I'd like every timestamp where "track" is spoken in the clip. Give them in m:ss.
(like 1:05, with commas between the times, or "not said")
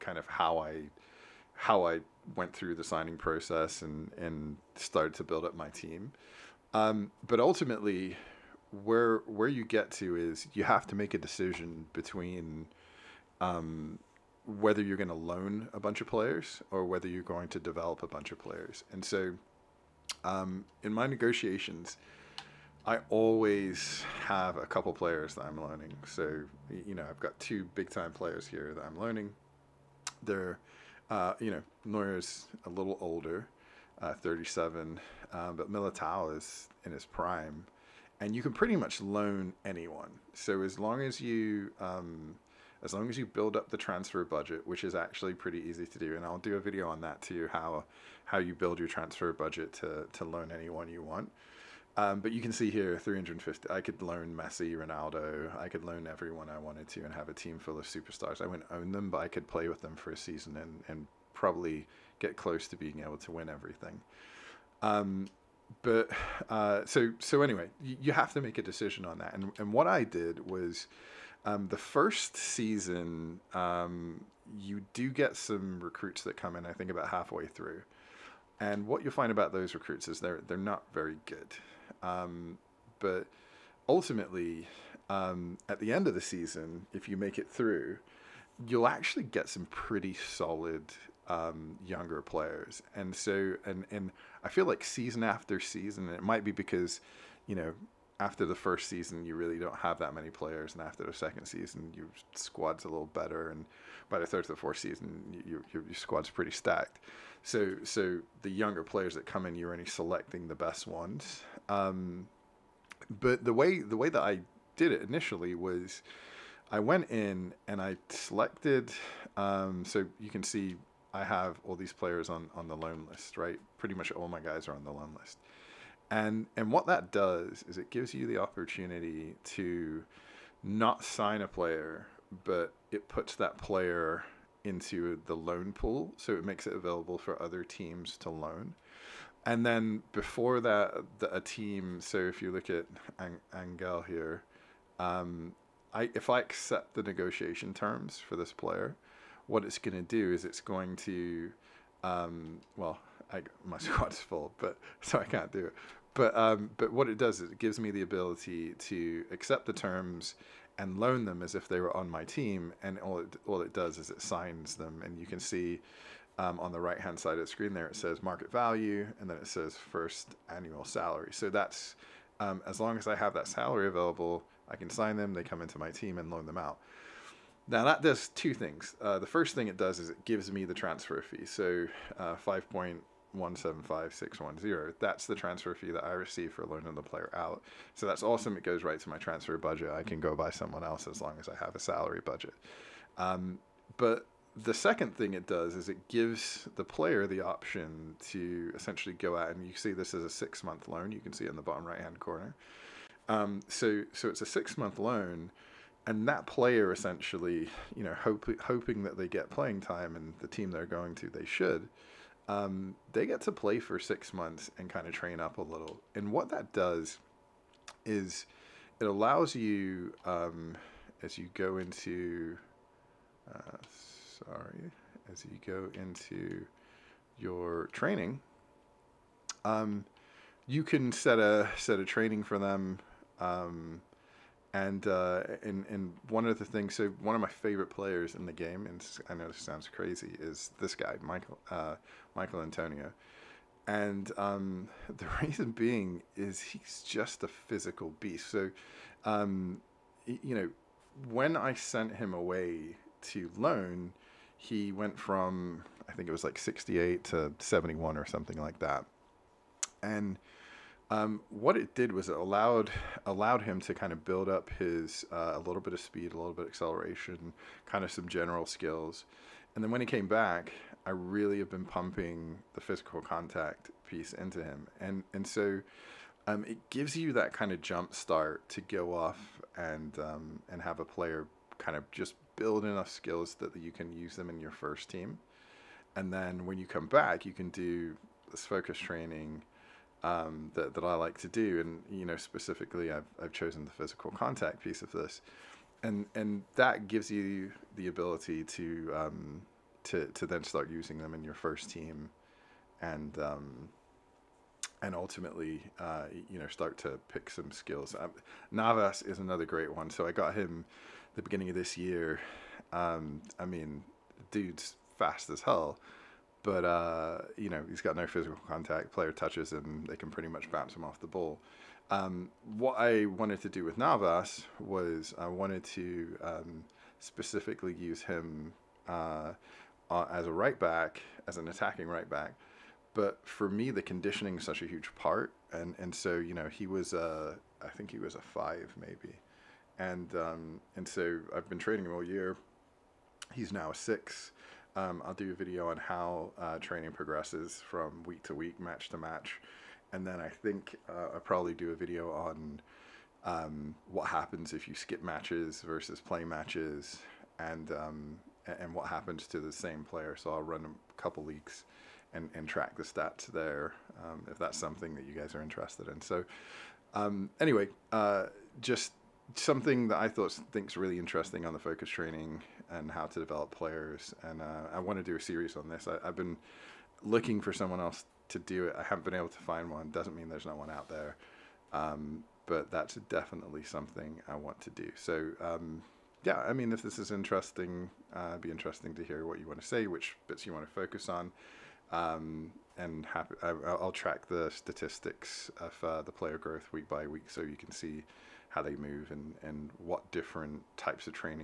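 6:02, 6:34.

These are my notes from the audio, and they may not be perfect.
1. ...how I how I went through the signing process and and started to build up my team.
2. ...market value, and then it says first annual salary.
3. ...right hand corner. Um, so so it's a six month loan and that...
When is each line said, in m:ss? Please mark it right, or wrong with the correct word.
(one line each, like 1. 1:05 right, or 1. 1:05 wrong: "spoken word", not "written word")
1. 0:00 right
2. 2:48 right
3. 3:21 right.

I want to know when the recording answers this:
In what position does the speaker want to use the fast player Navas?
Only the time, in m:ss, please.
5:31.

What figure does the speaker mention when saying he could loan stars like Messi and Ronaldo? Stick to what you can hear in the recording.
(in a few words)
350.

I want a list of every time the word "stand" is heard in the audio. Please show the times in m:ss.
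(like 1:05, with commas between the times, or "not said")
not said.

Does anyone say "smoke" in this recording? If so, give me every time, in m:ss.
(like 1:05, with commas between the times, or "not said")
not said.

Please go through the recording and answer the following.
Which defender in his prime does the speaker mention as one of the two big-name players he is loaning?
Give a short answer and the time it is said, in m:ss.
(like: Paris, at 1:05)
Militao, at 0:35.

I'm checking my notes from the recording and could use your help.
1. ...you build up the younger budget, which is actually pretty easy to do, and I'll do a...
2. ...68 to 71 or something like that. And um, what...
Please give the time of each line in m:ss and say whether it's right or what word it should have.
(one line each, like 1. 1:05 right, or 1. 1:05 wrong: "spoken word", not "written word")
1. 0:43 wrong: "transfer", not "younger"
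2. 4:16 right.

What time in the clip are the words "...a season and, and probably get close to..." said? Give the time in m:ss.
1:00.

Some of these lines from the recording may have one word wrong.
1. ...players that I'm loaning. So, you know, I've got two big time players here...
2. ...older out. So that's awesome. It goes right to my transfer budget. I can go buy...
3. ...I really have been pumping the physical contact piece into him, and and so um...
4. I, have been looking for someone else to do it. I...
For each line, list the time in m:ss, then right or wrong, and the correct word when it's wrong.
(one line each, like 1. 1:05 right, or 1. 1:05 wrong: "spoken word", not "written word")
1. 0:24 right
2. 3:07 wrong: "player", not "older"
3. 4:31 right
4. 6:16 right.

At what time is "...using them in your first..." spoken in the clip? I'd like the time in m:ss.
5:00.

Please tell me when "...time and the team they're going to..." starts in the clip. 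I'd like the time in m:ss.
3:29.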